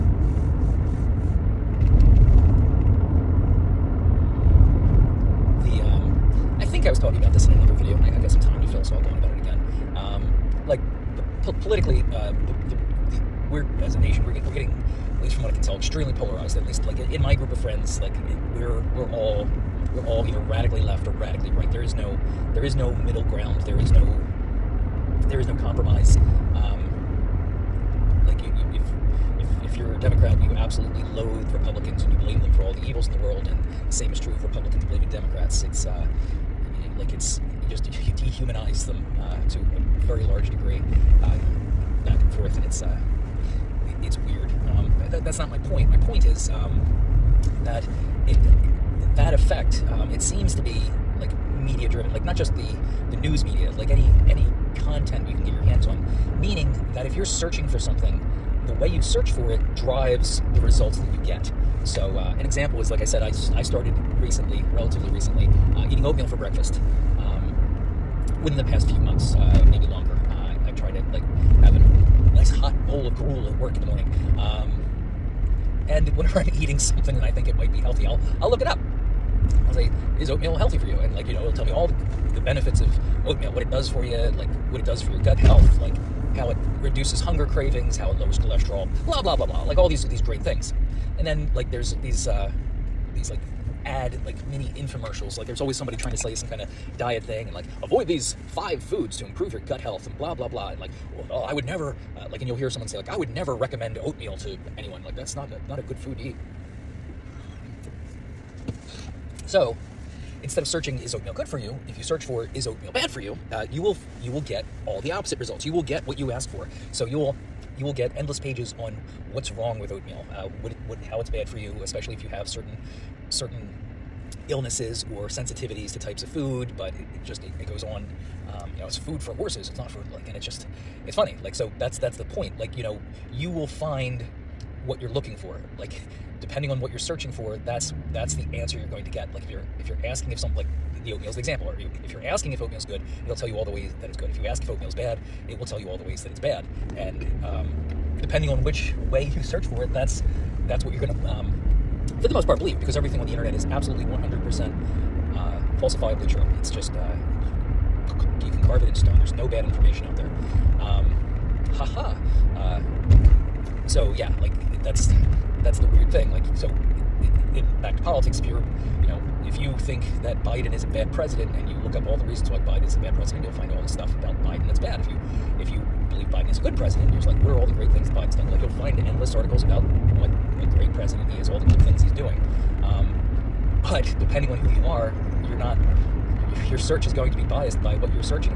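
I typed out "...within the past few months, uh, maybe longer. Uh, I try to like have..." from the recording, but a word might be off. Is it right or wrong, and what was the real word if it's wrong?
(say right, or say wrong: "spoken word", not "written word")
right.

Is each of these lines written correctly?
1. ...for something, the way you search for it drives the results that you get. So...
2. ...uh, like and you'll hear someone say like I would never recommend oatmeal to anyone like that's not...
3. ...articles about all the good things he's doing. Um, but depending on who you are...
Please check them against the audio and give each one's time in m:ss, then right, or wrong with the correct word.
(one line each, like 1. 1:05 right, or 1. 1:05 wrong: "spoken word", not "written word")
1. 0:57 right
2. 1:42 right
3. 2:59 right.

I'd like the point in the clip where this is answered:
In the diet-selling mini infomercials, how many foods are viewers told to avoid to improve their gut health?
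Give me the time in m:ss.
1:38.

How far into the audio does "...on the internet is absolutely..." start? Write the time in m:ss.
2:33.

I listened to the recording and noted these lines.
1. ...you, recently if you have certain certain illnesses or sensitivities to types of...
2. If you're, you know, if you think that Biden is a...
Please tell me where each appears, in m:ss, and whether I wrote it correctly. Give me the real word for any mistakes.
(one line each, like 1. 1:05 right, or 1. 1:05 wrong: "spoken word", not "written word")
1. 2:01 wrong: "especially", not "recently"
2. 2:48 right.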